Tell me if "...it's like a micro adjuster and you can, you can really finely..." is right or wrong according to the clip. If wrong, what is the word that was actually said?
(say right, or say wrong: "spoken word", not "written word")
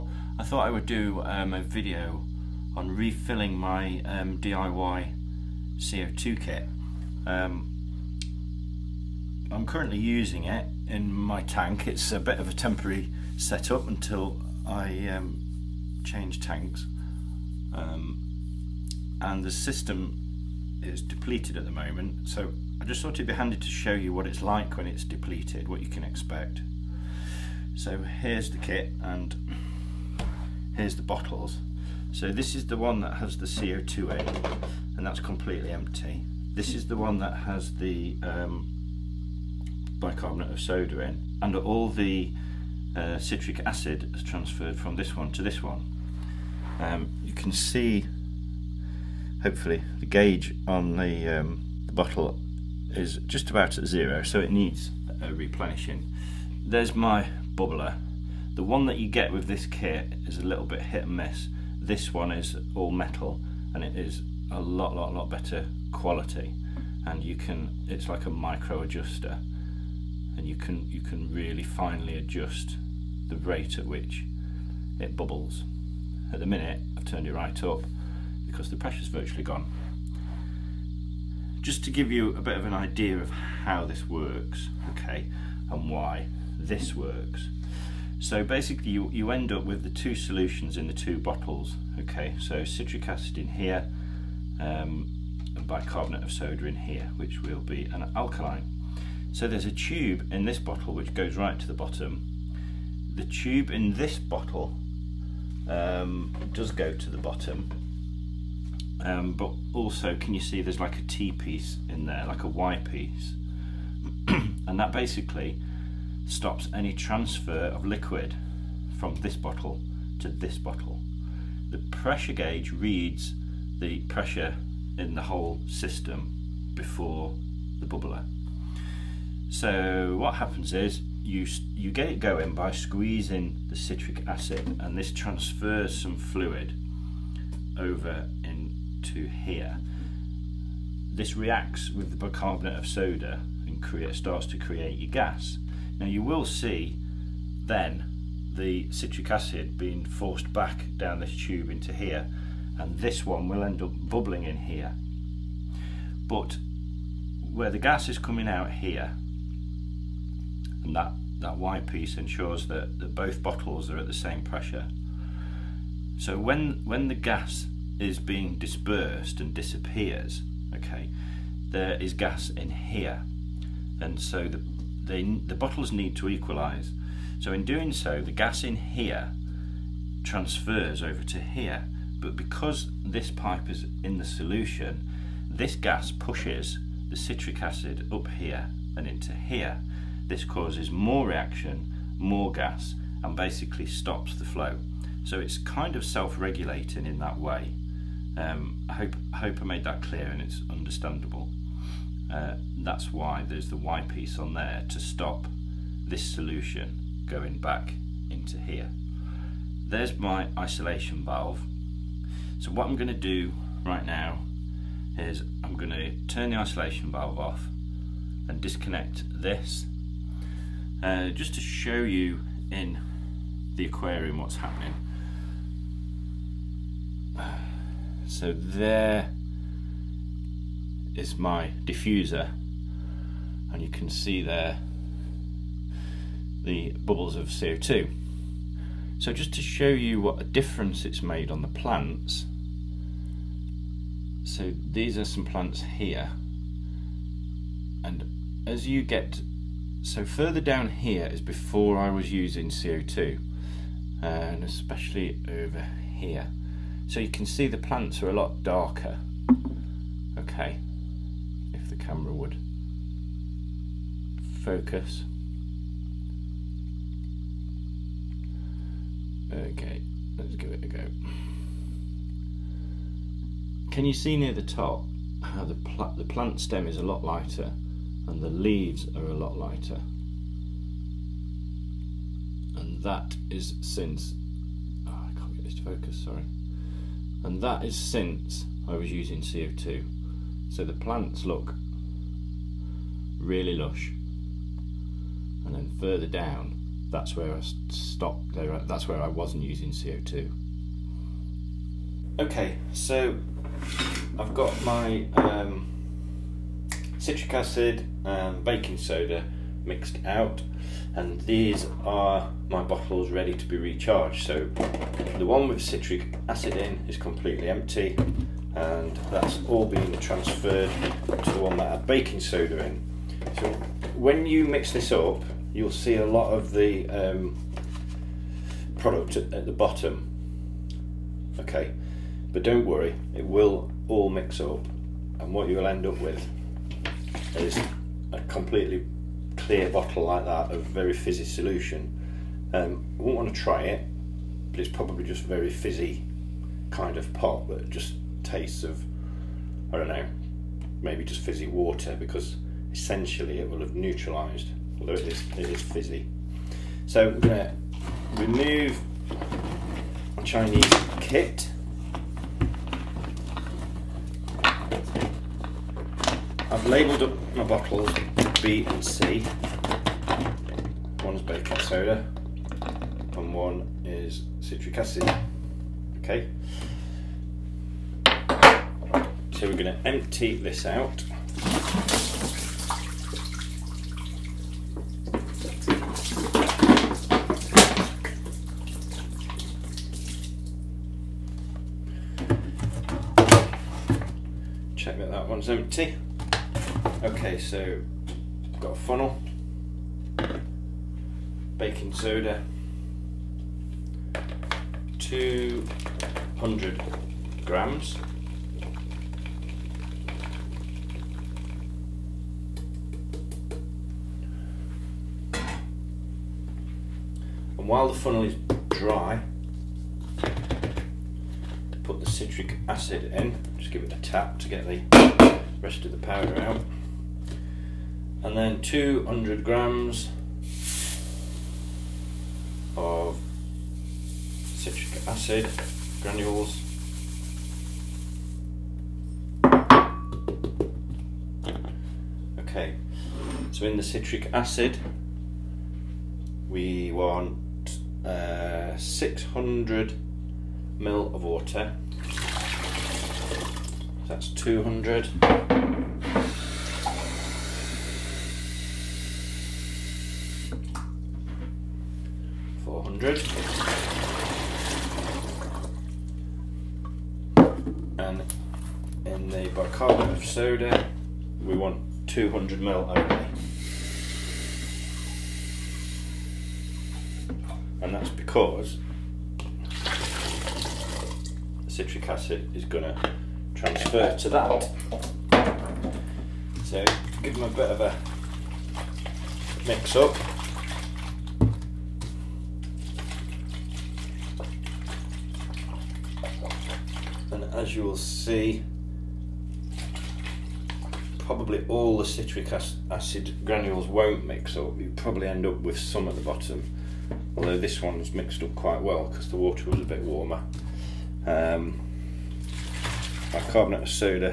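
right.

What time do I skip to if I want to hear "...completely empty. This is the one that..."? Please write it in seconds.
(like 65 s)
35 s.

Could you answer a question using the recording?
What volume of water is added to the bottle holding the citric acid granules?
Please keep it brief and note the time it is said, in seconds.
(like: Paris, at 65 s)
600 ml, at 448 s.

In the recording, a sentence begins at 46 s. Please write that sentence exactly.
Um, you can see hopefully the gauge on the, um, the bottle is just about at zero so it needs a replenishing.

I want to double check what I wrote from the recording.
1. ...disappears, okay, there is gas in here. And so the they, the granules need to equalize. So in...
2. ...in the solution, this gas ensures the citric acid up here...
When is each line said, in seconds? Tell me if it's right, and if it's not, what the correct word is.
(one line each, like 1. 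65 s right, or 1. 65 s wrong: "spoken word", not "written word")
1. 169 s wrong: "bottles", not "granules"
2. 184 s wrong: "pushes", not "ensures".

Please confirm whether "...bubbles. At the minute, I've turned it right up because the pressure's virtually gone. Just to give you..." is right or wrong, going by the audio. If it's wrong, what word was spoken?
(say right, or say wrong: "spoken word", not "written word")
right.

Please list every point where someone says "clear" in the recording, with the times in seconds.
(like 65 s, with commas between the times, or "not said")
200 s, 339 s.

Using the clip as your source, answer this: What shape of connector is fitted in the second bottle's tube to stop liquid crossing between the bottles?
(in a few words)
T piece.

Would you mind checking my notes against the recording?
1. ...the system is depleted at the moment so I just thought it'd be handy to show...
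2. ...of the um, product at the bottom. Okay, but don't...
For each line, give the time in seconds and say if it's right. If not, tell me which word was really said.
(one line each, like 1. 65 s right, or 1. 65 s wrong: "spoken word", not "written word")
1. 19 s right
2. 326 s right.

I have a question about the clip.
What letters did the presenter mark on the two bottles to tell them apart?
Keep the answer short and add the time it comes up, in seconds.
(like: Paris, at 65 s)
B and C, at 368 s.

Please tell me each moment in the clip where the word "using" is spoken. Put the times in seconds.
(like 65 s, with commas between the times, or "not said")
9 s, 252 s, 289 s, 299 s.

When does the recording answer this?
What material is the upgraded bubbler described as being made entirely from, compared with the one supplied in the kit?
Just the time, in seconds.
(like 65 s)
62 s.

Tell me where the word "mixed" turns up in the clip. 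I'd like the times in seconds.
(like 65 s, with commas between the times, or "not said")
309 s, 508 s.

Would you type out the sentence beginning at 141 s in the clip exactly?
This reacts with the bicarbonate of soda and create, starts to create your gas.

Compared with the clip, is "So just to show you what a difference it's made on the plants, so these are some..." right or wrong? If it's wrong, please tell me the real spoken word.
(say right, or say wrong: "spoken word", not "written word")
right.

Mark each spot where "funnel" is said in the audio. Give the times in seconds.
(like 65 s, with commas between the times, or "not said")
398 s, 418 s.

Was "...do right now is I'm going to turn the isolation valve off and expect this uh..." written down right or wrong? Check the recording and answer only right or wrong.
wrong.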